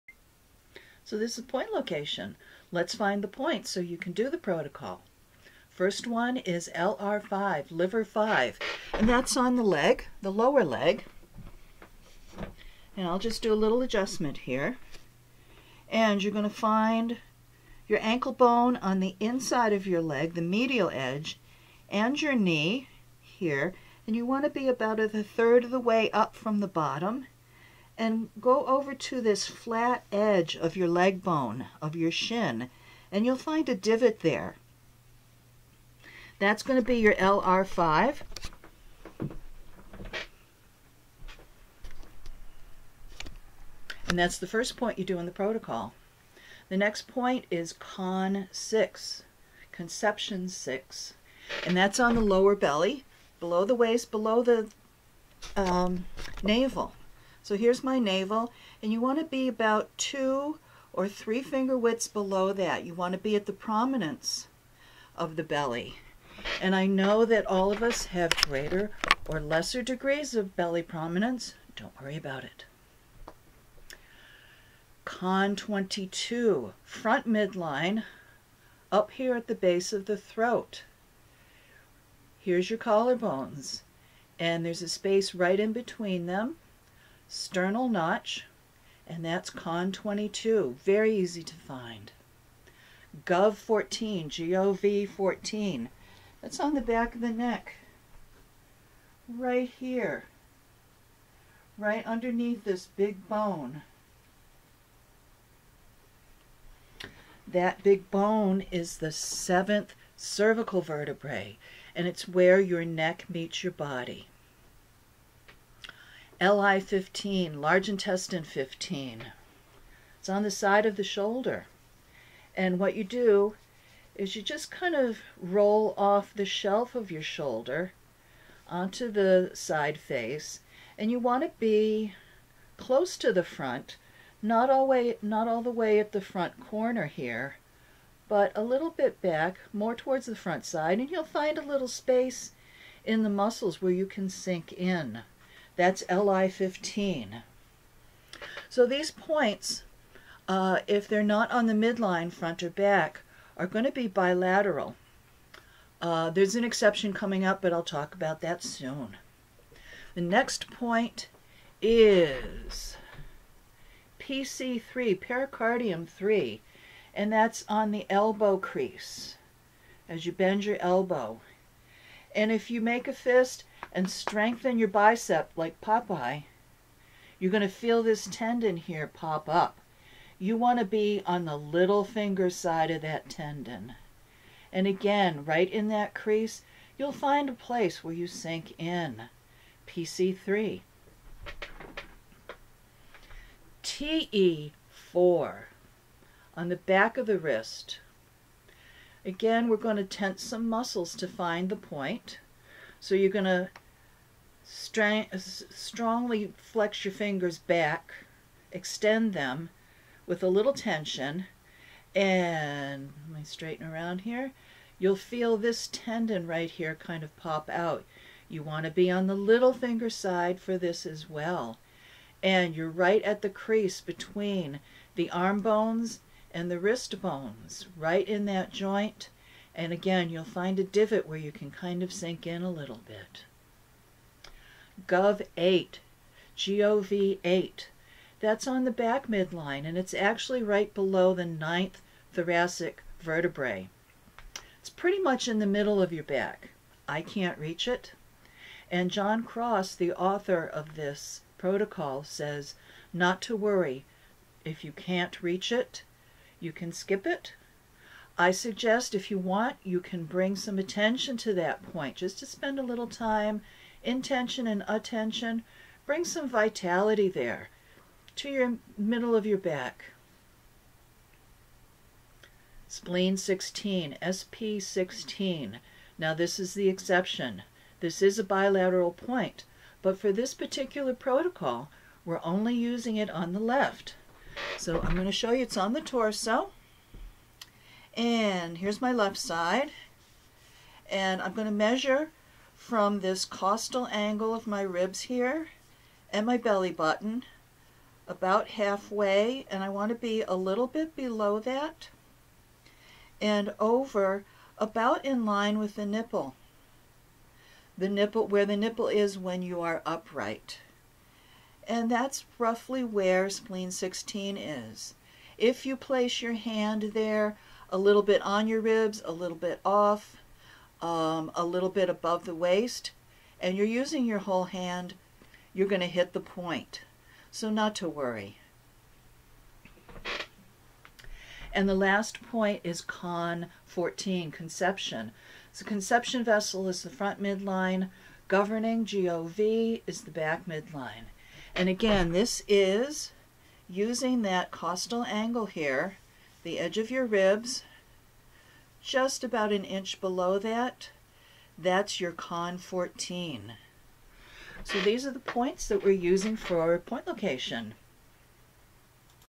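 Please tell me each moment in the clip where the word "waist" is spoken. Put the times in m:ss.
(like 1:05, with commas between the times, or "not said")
0:53, 5:22.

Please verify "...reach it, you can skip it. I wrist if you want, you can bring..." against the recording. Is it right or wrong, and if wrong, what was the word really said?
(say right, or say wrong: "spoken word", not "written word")
wrong: "suggest", not "wrist".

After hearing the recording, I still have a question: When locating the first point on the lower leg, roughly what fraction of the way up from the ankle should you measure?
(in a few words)
a third.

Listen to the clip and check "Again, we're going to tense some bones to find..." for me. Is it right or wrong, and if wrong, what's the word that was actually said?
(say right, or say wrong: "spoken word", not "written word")
wrong: "muscles", not "bones".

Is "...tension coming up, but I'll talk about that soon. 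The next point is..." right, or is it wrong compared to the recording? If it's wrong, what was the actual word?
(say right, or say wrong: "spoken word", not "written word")
wrong: "exception", not "tension".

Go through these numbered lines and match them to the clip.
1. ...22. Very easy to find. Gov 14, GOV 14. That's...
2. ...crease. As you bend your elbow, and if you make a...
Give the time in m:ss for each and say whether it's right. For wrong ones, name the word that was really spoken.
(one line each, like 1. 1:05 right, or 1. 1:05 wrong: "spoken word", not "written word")
1. 1:29 right
2. 2:48 right.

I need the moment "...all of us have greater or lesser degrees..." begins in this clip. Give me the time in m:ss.
1:07.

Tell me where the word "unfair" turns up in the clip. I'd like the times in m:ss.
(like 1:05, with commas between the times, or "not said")
not said.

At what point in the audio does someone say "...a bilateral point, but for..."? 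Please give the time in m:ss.
4:38.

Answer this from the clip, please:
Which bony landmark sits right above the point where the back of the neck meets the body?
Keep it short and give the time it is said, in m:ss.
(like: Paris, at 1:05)
seventh cervical vertebrae, at 1:49.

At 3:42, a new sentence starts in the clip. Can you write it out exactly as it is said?
And you're right at the crease between the arm bones and the wrist bones, right in that joint.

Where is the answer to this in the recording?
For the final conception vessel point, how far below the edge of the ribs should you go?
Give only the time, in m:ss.
5:49.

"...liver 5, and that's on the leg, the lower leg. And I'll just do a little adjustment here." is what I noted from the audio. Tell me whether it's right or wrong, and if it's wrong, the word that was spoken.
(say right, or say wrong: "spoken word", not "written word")
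right.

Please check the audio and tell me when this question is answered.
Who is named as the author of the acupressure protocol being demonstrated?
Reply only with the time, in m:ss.
4:09.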